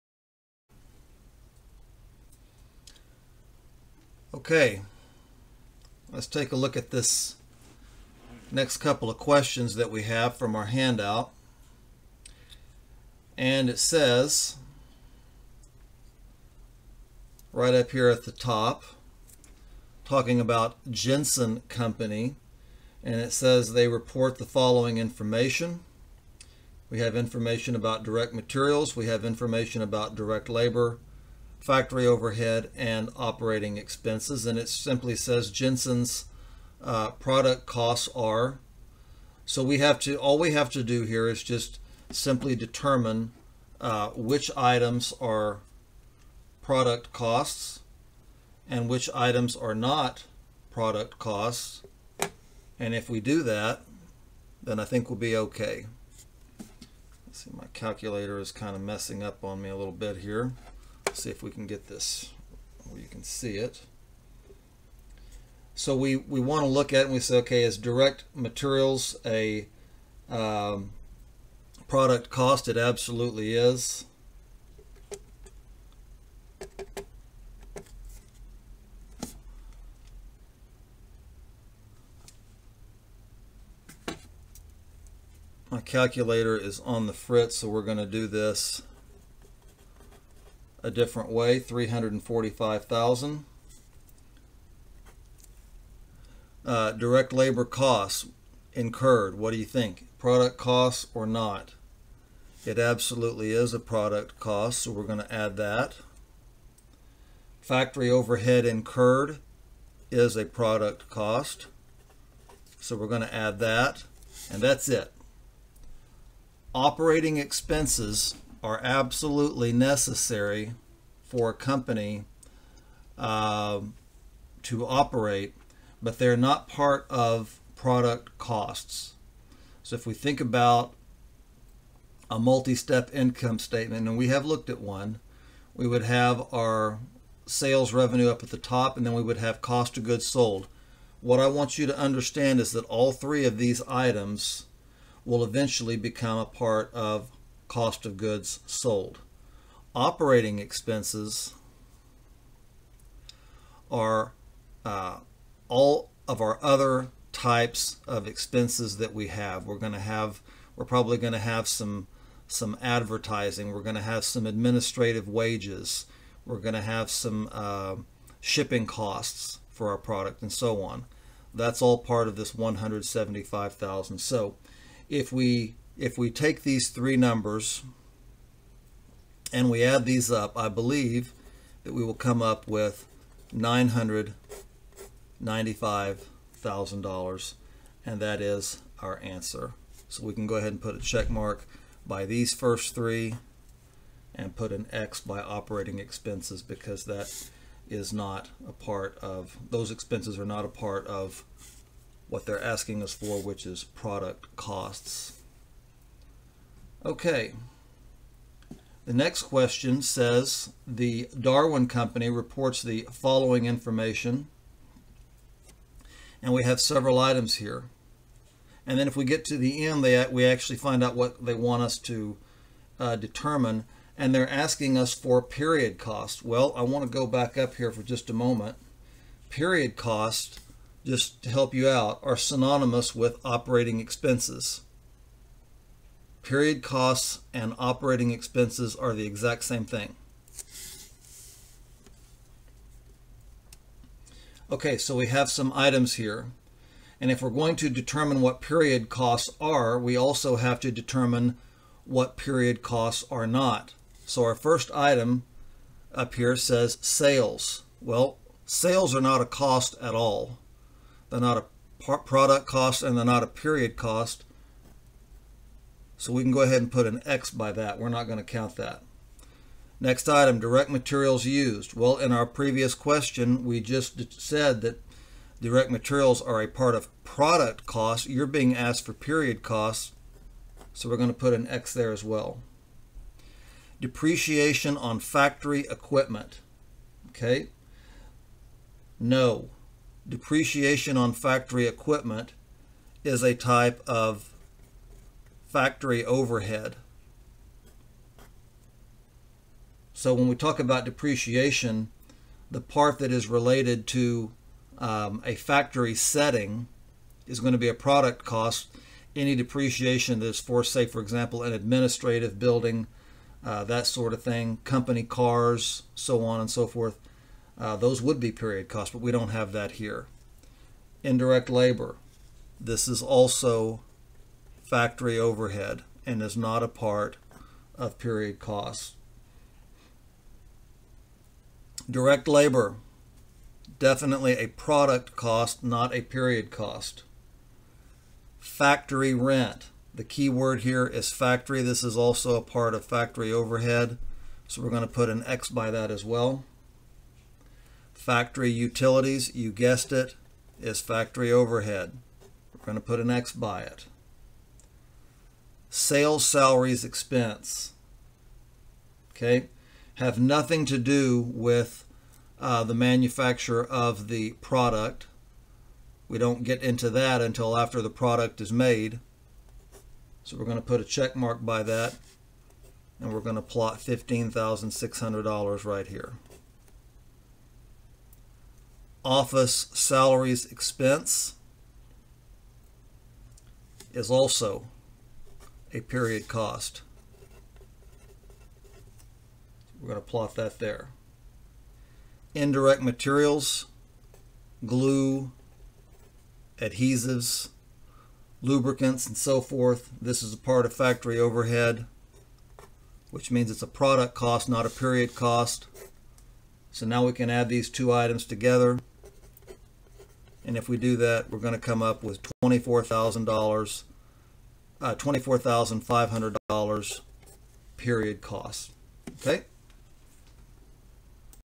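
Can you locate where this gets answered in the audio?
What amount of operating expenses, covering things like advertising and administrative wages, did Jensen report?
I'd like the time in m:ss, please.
2:52.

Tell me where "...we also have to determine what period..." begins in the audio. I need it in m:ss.
4:09.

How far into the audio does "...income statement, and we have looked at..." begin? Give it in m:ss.
2:13.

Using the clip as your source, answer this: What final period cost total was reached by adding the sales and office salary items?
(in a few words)
$24,500.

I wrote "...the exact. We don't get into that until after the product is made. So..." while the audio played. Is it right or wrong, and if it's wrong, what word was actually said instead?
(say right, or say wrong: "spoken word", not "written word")
wrong: "product", not "exact".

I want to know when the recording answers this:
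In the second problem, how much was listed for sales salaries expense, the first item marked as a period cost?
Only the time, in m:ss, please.
6:13.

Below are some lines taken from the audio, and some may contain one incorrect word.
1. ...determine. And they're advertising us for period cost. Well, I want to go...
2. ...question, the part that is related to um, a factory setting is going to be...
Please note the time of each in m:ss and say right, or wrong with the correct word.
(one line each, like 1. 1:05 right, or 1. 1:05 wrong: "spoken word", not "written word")
1. 3:43 wrong: "asking", not "advertising"
2. 5:01 wrong: "depreciation", not "question".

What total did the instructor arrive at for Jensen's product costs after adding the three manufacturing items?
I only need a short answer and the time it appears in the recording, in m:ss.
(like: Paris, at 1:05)
$995,000, at 3:03.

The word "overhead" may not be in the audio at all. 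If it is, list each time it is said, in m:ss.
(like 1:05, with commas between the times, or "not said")
0:32, 1:48, 4:56, 5:25, 5:43, 5:51, 6:41.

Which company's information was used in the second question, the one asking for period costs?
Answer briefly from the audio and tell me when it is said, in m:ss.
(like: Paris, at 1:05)
Darwin Company, at 3:31.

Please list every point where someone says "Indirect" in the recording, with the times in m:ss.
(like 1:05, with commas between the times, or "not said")
5:21, 6:32.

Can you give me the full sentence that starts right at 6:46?
So now we can add these two items together.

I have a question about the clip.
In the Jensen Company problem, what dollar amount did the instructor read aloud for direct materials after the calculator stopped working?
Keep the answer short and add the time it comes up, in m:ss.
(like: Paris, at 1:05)
345,000, at 1:31.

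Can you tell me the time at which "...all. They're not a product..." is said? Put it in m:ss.
4:20.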